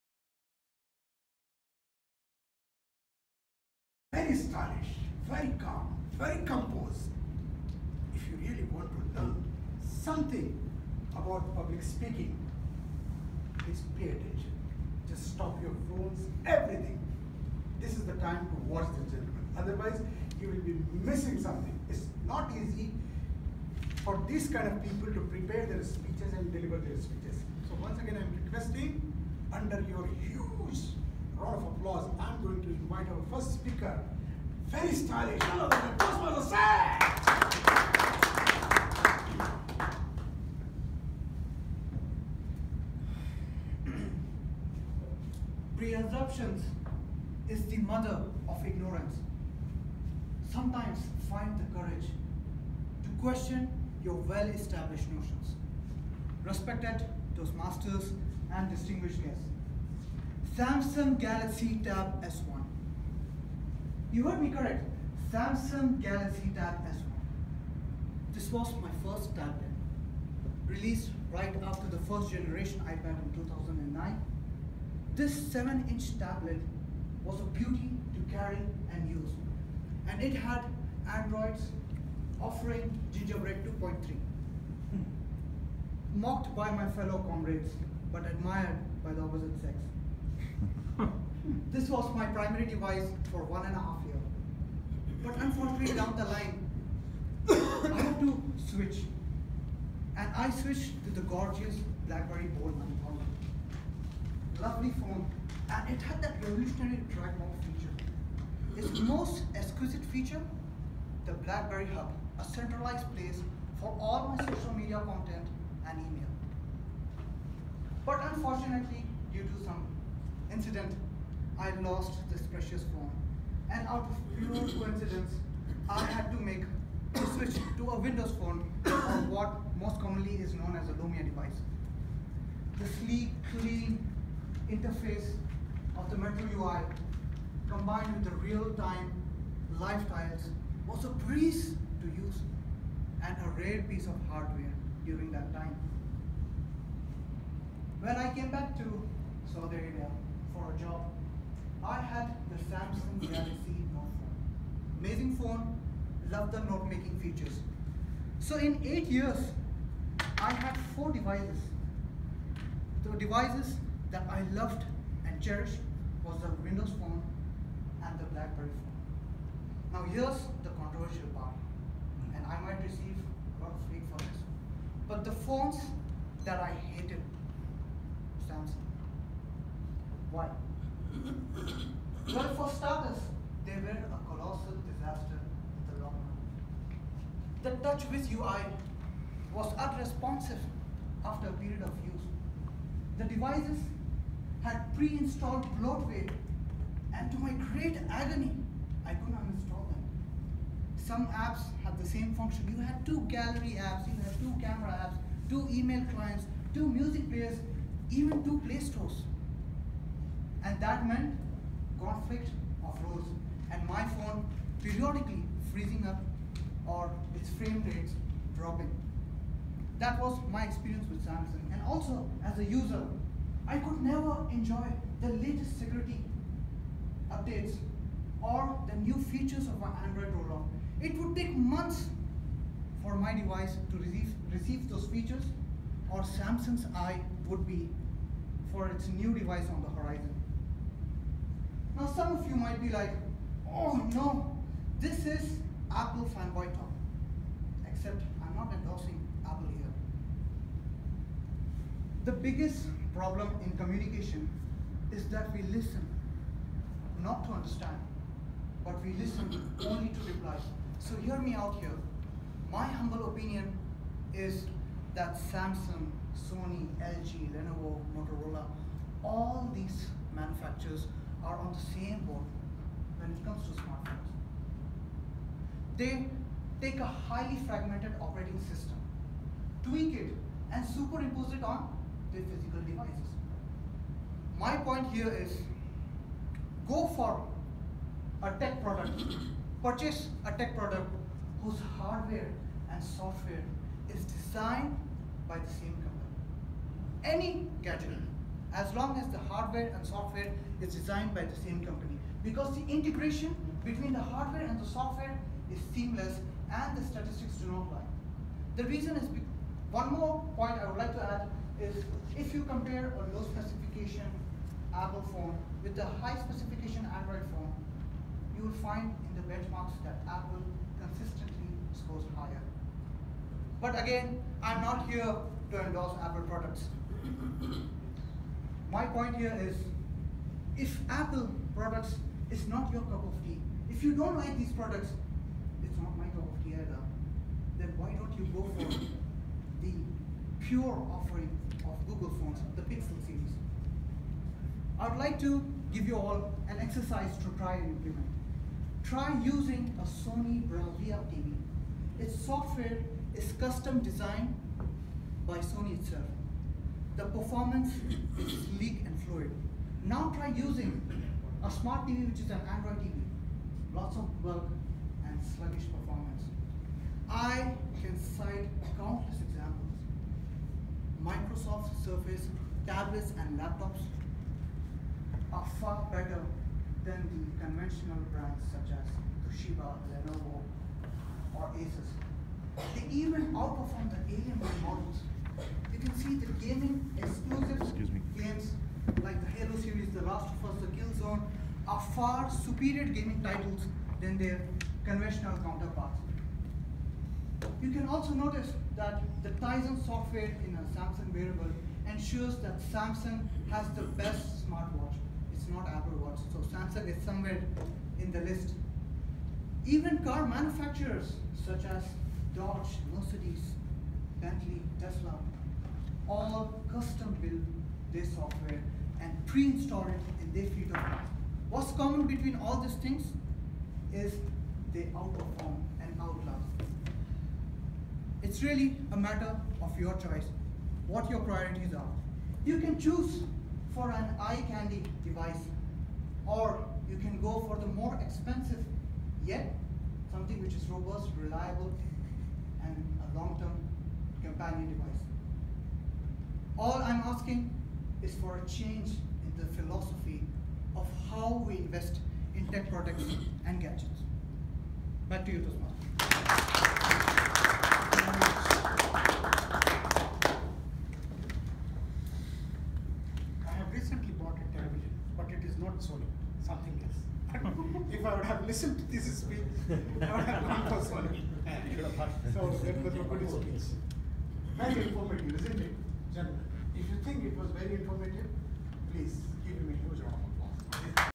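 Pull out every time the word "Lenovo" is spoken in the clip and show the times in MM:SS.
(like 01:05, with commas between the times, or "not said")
04:27, 06:20.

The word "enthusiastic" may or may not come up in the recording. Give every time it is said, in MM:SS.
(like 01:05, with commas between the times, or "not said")
not said.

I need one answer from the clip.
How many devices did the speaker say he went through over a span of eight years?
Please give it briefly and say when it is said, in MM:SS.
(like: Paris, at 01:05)
4, at 02:40.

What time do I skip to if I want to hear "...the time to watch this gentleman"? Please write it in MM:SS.
00:18.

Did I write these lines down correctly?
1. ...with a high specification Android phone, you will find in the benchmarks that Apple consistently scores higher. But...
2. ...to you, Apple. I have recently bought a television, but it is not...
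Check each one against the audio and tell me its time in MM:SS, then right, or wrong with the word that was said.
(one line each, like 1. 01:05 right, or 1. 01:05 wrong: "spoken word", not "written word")
1. 05:15 right
2. 07:35 wrong: "Toastmaster", not "Apple".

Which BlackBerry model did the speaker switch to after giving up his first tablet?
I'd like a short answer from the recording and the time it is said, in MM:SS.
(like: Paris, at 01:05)
BlackBerry Bold 9000, at 01:42.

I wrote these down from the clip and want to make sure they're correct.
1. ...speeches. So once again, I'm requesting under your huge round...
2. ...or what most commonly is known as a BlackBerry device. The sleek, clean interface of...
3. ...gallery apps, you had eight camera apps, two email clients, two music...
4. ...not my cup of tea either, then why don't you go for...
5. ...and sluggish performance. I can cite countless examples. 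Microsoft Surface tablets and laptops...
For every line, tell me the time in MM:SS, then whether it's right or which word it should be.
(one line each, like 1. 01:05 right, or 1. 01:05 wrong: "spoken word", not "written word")
1. 00:26 right
2. 02:08 wrong: "Lumia", not "BlackBerry"
3. 03:23 wrong: "two", not "eight"
4. 05:35 right
5. 06:05 right.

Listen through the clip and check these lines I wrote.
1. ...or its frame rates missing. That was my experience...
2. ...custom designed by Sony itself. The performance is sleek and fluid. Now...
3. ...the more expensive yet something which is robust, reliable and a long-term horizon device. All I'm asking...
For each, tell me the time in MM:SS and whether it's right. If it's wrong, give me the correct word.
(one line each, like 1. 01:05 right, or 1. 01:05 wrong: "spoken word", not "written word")
1. 03:36 wrong: "dropping", not "missing"
2. 05:53 right
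3. 07:17 wrong: "companion", not "horizon".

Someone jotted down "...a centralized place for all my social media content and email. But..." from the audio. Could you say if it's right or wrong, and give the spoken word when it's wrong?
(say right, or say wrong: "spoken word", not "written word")
right.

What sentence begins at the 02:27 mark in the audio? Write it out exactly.
When I came back to Saudi Arabia, Amazing phone, love the note making features.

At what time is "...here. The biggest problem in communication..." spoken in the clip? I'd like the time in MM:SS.
04:09.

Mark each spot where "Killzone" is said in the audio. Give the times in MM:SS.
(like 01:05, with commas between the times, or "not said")
06:30.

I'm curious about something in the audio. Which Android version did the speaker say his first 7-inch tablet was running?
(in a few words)
Gingerbread 2.3.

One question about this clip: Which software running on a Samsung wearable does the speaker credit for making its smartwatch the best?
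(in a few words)
Tizen.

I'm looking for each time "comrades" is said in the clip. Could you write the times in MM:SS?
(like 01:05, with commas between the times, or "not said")
01:27.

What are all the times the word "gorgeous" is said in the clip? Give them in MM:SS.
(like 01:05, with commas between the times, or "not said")
01:41.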